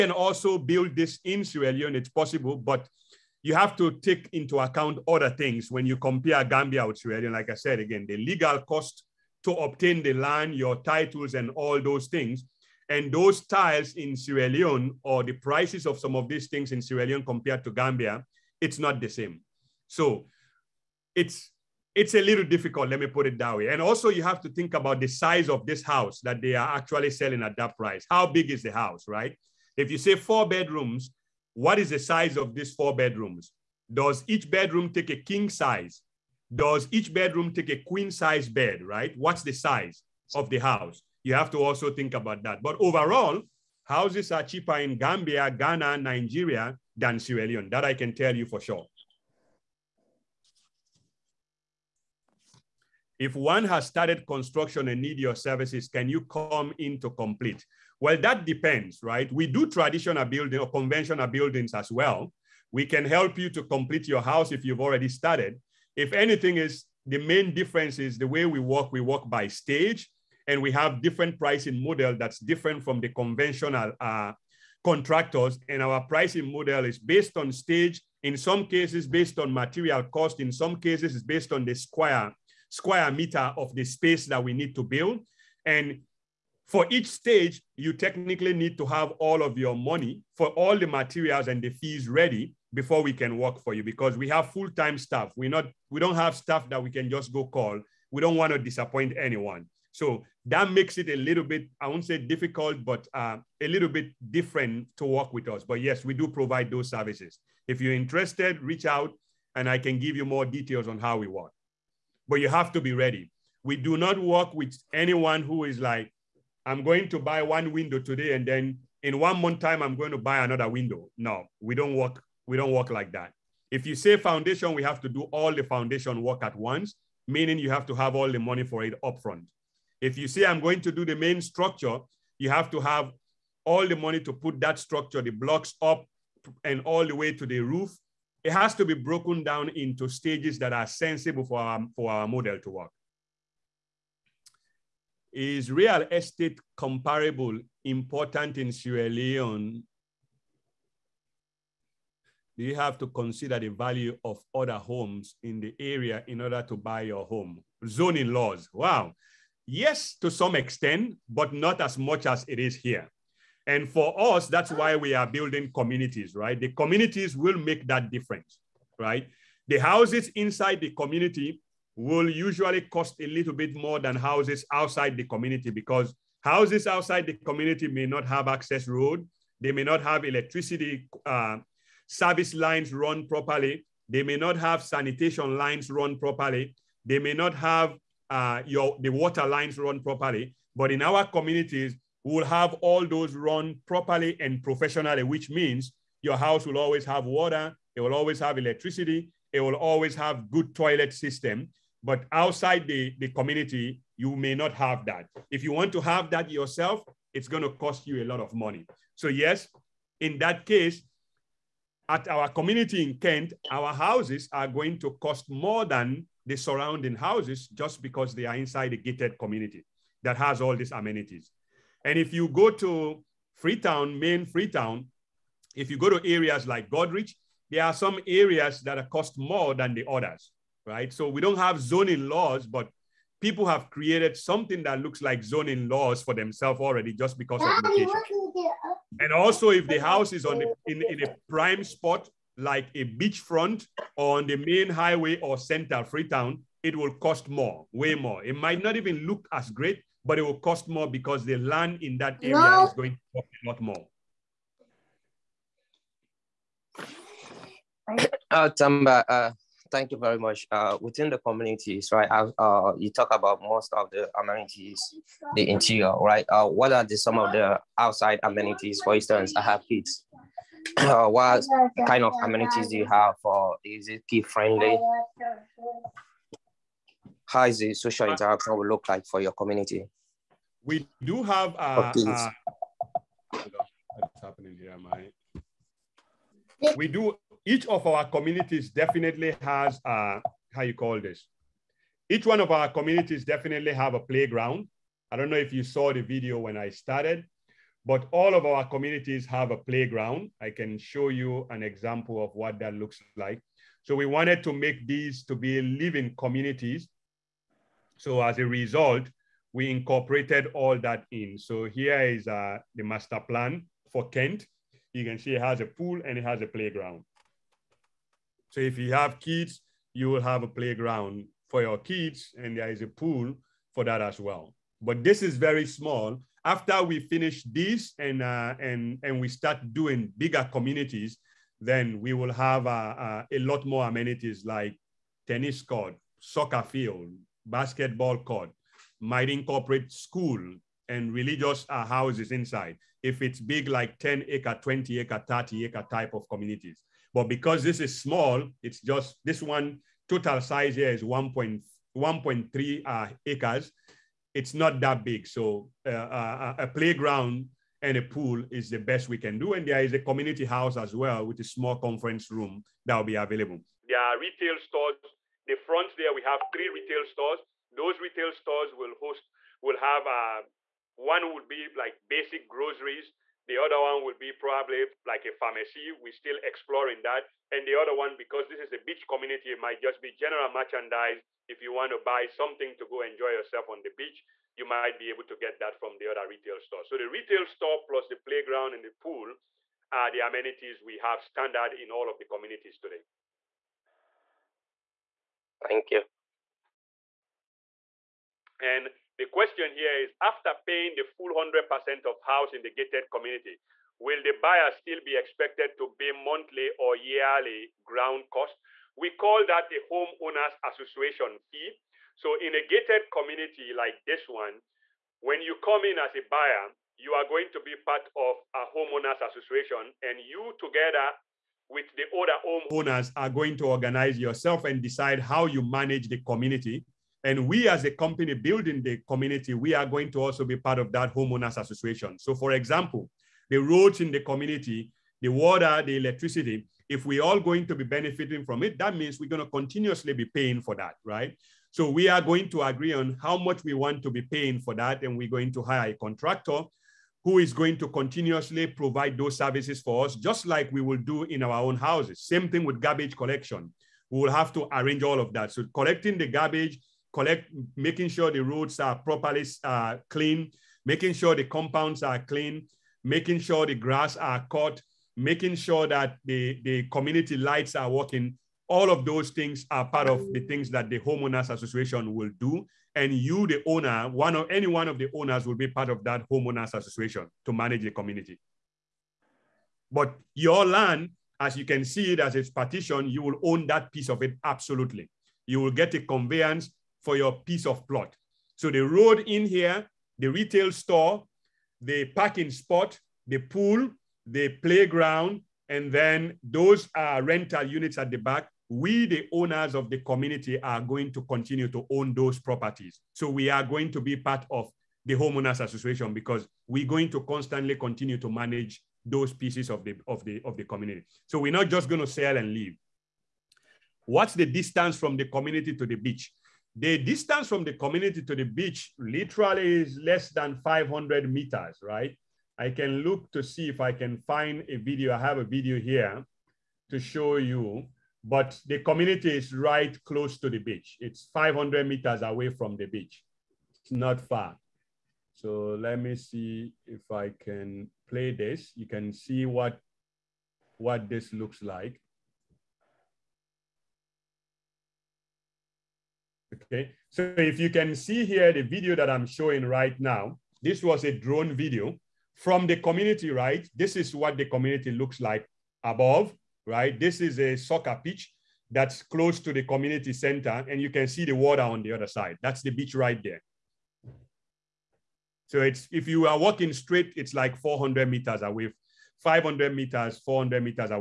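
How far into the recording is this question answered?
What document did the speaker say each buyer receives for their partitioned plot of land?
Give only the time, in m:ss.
8:06.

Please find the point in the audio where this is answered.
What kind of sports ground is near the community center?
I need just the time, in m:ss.
9:17.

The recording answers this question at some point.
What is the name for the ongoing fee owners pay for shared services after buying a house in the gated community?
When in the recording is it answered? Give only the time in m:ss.
6:50.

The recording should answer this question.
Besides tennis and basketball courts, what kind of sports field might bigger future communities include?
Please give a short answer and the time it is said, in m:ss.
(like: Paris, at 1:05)
soccer field, at 5:36.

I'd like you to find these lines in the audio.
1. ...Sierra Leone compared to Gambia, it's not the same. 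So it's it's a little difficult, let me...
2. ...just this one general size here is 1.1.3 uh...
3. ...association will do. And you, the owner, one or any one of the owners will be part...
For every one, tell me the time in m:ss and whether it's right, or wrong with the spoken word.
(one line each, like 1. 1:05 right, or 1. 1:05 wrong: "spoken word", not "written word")
1. 0:16 right
2. 5:49 wrong: "total", not "general"
3. 7:51 right.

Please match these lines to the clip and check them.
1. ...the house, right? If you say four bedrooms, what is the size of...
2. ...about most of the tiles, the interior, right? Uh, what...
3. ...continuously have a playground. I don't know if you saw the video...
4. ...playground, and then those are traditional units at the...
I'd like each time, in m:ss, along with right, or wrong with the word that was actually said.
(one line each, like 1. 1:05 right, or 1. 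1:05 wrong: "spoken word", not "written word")
1. 0:28 right
2. 4:23 wrong: "amenities", not "tiles"
3. 4:53 wrong: "definitely", not "continuously"
4. 8:14 wrong: "rental", not "traditional".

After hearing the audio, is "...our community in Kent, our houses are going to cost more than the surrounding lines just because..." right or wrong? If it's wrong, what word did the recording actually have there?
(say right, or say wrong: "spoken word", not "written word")
wrong: "houses", not "lines".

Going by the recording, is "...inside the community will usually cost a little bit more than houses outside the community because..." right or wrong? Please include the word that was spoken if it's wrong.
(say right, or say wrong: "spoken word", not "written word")
right.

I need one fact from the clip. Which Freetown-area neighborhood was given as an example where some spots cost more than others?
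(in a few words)
Goderich.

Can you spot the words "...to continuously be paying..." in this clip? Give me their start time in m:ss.
7:19.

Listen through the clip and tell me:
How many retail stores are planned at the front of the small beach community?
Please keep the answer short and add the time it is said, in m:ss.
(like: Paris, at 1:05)
3, at 6:06.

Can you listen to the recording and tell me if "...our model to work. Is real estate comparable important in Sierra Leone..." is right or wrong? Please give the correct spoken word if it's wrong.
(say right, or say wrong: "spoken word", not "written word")
right.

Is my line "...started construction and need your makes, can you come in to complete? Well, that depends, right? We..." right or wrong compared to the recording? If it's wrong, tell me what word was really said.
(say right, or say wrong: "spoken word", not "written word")
wrong: "services", not "makes".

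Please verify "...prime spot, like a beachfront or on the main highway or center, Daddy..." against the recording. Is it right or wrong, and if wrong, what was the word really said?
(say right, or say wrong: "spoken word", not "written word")
wrong: "Freetown", not "Daddy".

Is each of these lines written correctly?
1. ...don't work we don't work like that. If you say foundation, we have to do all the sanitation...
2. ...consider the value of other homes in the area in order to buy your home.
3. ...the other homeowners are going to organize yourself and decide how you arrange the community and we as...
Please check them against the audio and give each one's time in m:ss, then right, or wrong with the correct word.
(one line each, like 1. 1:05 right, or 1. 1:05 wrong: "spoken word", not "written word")
1. 2:01 wrong: "foundation", not "sanitation"
2. 2:33 right
3. 7:02 wrong: "manage", not "arrange".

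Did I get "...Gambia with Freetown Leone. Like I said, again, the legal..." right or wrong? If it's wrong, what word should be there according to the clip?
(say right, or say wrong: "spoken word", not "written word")
wrong: "Sierra", not "Freetown".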